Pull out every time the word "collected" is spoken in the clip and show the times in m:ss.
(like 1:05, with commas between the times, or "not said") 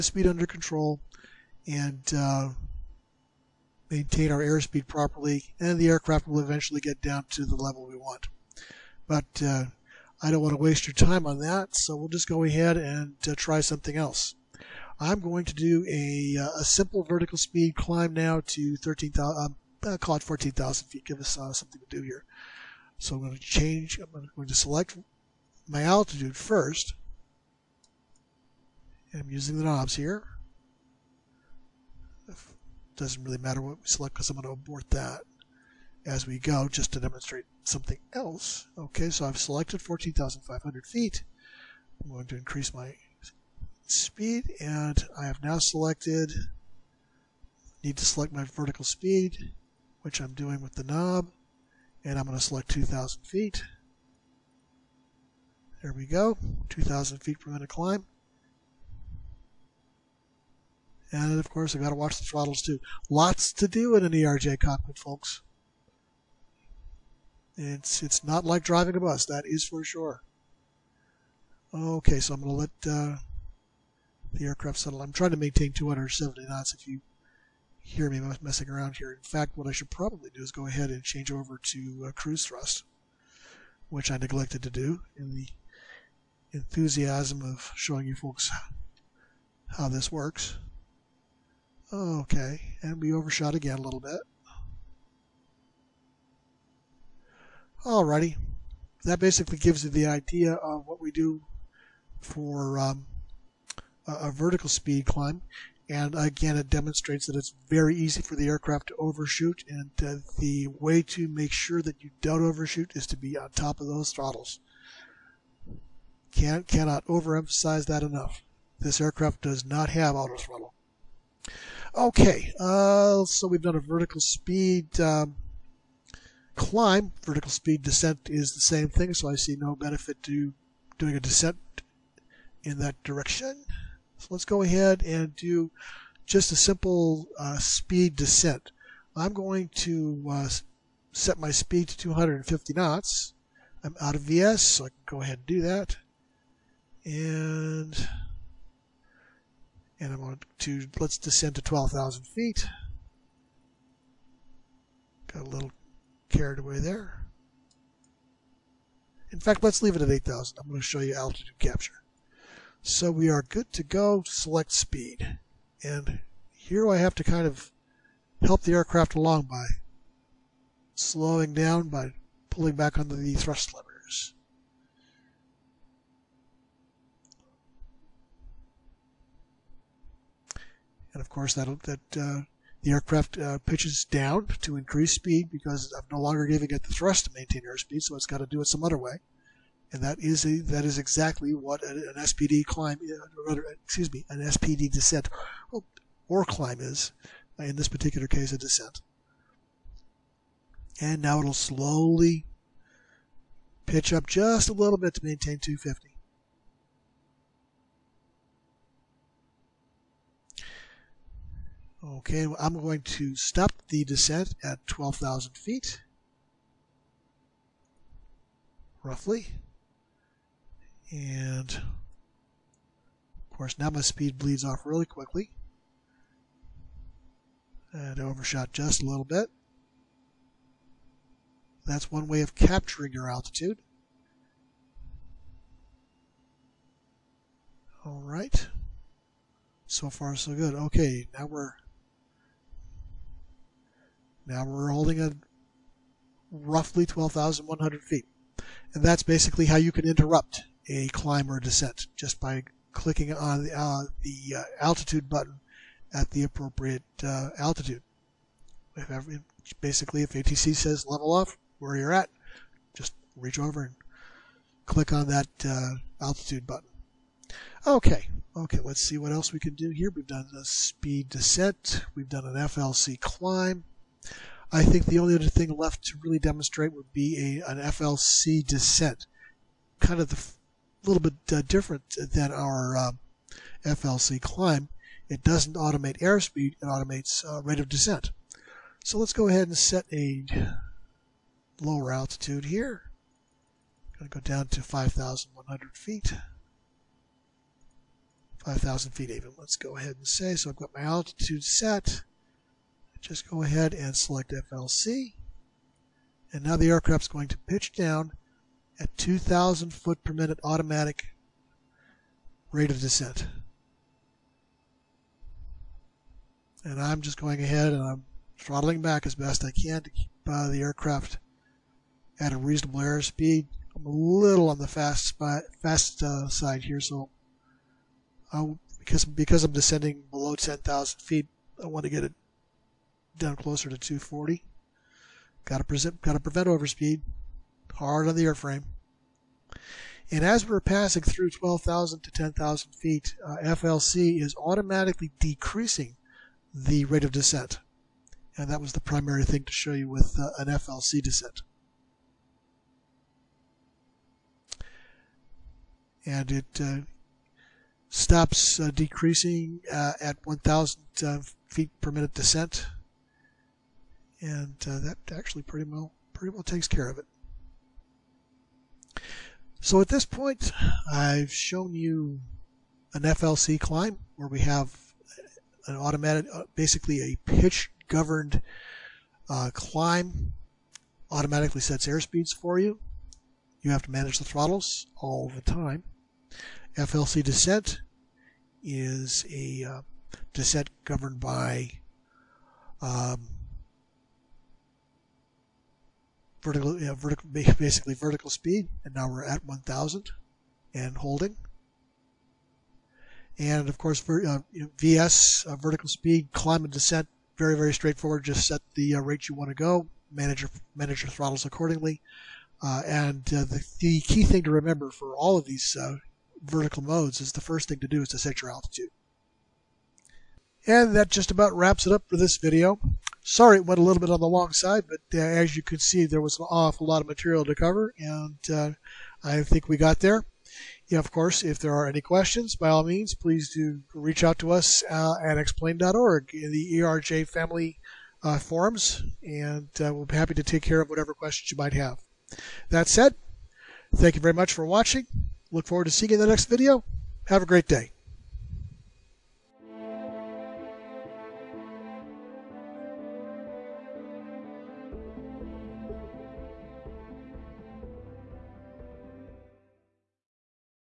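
not said.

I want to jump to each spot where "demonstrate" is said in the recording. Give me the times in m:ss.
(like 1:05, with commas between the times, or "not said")
0:36, 1:46, 4:36.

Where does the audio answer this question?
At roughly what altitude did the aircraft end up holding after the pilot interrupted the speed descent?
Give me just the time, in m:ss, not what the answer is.
4:07.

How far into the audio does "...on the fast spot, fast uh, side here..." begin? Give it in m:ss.
5:24.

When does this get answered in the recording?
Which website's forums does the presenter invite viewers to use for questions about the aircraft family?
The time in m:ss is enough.
7:15.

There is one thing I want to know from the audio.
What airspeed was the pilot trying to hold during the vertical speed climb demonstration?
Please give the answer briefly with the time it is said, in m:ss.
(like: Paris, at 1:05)
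270 knots, at 1:15.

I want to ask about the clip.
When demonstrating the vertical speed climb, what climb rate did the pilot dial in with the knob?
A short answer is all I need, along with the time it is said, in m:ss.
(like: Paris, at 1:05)
2,000 feet per minute, at 0:56.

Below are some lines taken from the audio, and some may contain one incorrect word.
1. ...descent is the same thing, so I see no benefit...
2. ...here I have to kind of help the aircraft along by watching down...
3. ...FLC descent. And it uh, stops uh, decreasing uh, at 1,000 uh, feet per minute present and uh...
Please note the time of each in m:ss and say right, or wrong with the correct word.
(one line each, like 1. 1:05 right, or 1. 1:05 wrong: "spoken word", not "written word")
1. 2:07 right
2. 2:46 wrong: "slowing", not "watching"
3. 5:50 wrong: "descent", not "present".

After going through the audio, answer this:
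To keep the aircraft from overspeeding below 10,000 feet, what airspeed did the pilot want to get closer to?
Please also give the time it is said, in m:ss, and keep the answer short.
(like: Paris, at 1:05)
240, at 5:33.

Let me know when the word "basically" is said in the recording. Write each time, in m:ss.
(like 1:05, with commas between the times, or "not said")
1:39, 4:09, 4:19, 6:16, 6:37.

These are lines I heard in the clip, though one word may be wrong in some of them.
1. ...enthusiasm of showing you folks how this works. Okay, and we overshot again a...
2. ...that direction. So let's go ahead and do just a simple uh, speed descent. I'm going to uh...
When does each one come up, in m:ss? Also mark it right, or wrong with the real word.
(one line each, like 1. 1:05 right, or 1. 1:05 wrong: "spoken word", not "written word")
1. 1:26 right
2. 2:12 right.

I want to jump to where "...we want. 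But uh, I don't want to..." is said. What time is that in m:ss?
0:07.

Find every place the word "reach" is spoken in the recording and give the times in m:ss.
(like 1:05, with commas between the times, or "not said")
4:23, 7:14.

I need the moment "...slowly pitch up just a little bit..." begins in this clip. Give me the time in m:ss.
3:21.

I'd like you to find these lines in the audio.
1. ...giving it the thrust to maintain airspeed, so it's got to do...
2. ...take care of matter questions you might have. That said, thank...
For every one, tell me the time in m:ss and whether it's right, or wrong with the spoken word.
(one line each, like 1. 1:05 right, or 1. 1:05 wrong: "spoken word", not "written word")
1. 3:06 right
2. 7:20 wrong: "whatever", not "matter".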